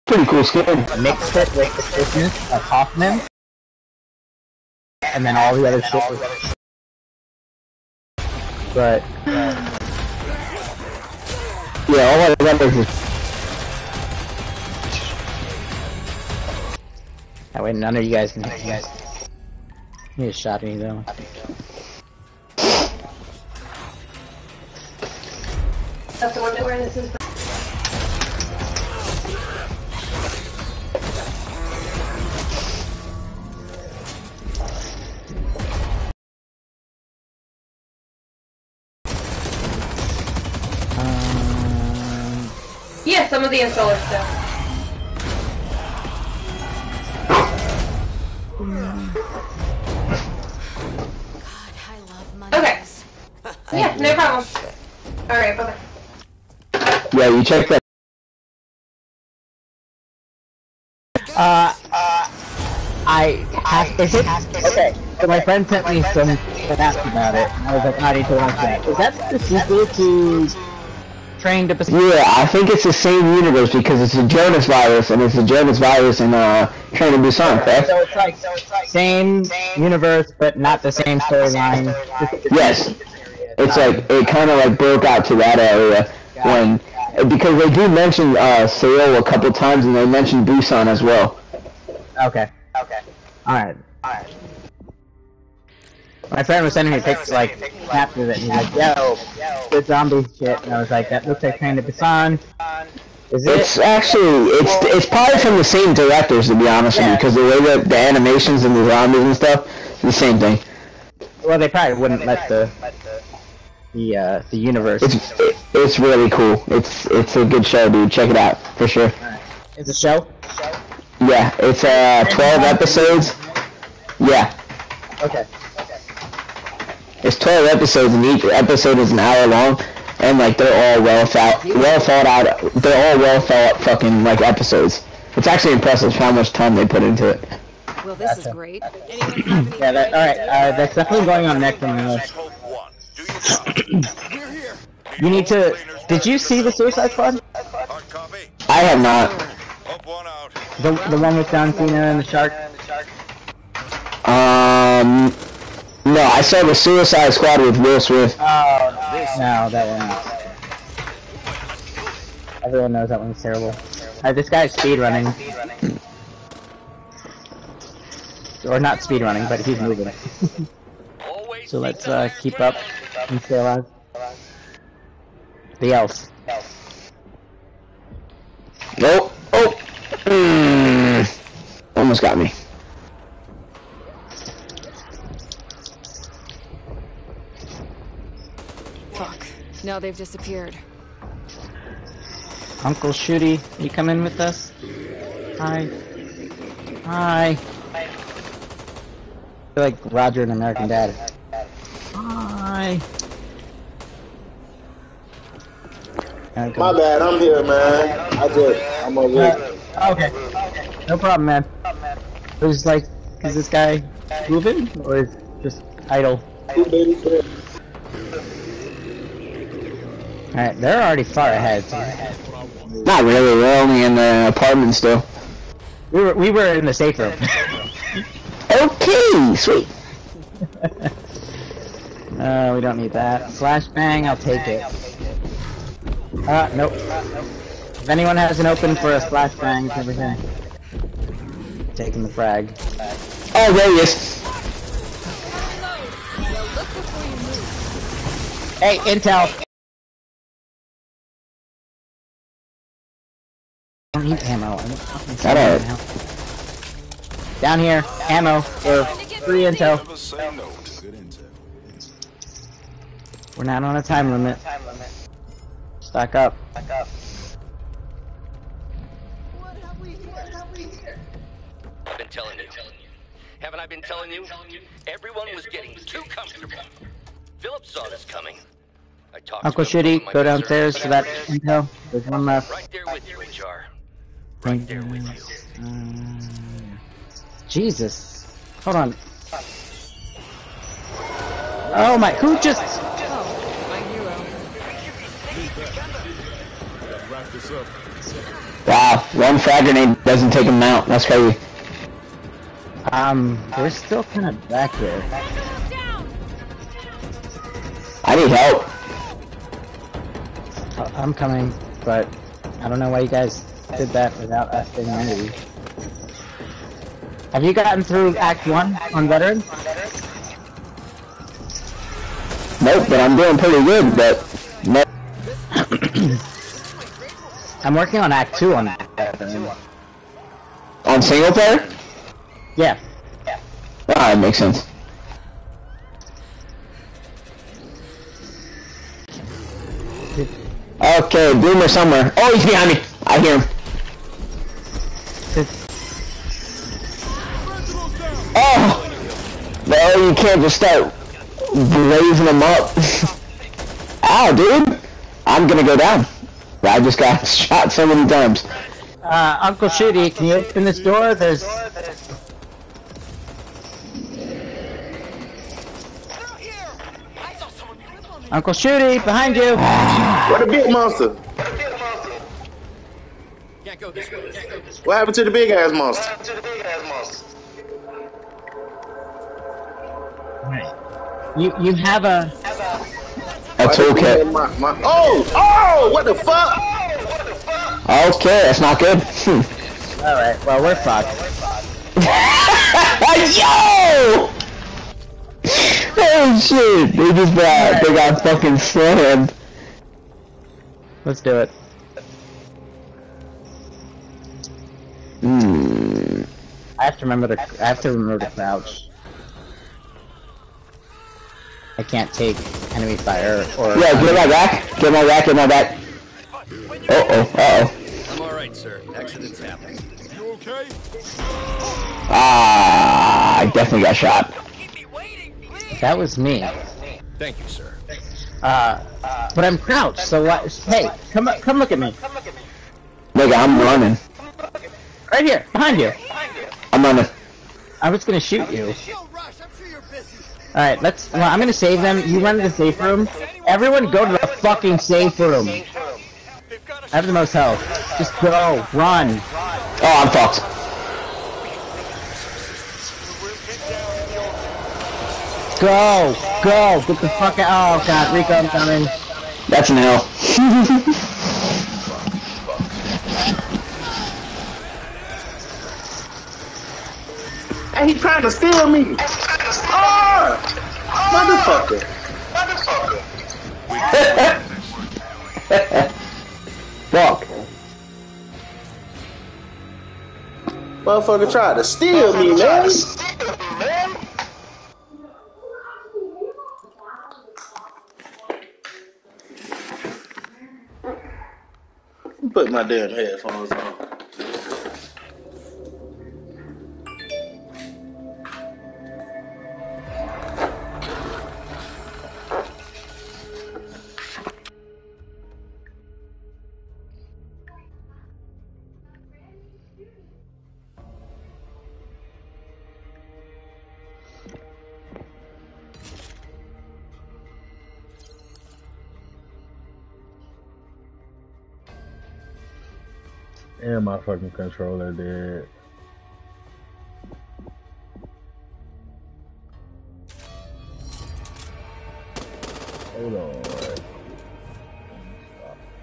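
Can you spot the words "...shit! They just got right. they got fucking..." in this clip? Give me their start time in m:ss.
6:36.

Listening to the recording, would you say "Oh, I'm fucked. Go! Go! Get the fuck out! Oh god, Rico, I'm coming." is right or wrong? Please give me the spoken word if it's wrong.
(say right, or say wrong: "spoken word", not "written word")
right.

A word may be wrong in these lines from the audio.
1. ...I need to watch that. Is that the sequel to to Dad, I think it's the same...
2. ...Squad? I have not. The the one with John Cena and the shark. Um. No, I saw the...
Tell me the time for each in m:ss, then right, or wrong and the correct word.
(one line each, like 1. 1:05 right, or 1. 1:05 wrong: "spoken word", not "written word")
1. 1:08 wrong: "Yeah", not "Dad"
2. 2:27 right.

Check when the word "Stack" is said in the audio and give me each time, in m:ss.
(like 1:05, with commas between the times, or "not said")
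4:26.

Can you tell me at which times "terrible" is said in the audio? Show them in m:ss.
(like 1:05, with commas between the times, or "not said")
2:43.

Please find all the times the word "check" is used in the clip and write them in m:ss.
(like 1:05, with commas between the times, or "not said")
0:57, 1:58.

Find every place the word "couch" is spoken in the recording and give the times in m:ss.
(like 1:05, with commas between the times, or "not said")
not said.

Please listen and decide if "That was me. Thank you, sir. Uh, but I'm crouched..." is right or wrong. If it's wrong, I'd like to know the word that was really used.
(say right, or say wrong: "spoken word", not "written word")
right.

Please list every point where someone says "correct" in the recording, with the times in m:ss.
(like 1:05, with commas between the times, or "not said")
1:17.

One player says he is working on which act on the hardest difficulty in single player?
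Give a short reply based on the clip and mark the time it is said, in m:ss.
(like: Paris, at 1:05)
Act 2, at 5:28.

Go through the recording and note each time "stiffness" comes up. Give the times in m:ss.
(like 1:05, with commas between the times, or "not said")
0:01.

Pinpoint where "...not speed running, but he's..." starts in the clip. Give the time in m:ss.
2:48.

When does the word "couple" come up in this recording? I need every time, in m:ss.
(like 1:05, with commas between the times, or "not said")
1:29.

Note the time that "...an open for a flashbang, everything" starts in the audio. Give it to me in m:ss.
3:58.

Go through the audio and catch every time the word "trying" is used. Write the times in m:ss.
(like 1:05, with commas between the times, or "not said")
7:48.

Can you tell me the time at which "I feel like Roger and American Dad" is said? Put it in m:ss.
3:17.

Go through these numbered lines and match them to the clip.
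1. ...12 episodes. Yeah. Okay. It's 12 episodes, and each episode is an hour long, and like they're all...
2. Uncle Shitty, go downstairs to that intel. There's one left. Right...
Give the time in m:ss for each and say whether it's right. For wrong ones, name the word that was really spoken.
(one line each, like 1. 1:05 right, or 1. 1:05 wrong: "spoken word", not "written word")
1. 2:02 right
2. 4:39 right.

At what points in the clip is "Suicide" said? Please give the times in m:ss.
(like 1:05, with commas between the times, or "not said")
2:26, 2:36.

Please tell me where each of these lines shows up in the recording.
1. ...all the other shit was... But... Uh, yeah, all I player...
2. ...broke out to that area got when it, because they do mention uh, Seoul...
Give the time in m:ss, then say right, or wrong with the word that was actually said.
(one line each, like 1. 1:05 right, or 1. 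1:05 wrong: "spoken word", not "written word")
1. 0:05 wrong: "remember", not "player"
2. 1:24 right.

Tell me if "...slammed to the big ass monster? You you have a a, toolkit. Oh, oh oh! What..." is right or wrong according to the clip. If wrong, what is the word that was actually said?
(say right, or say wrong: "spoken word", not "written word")
wrong: "happened", not "slammed".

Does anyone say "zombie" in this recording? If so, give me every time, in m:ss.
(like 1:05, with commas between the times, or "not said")
1:39, 1:48.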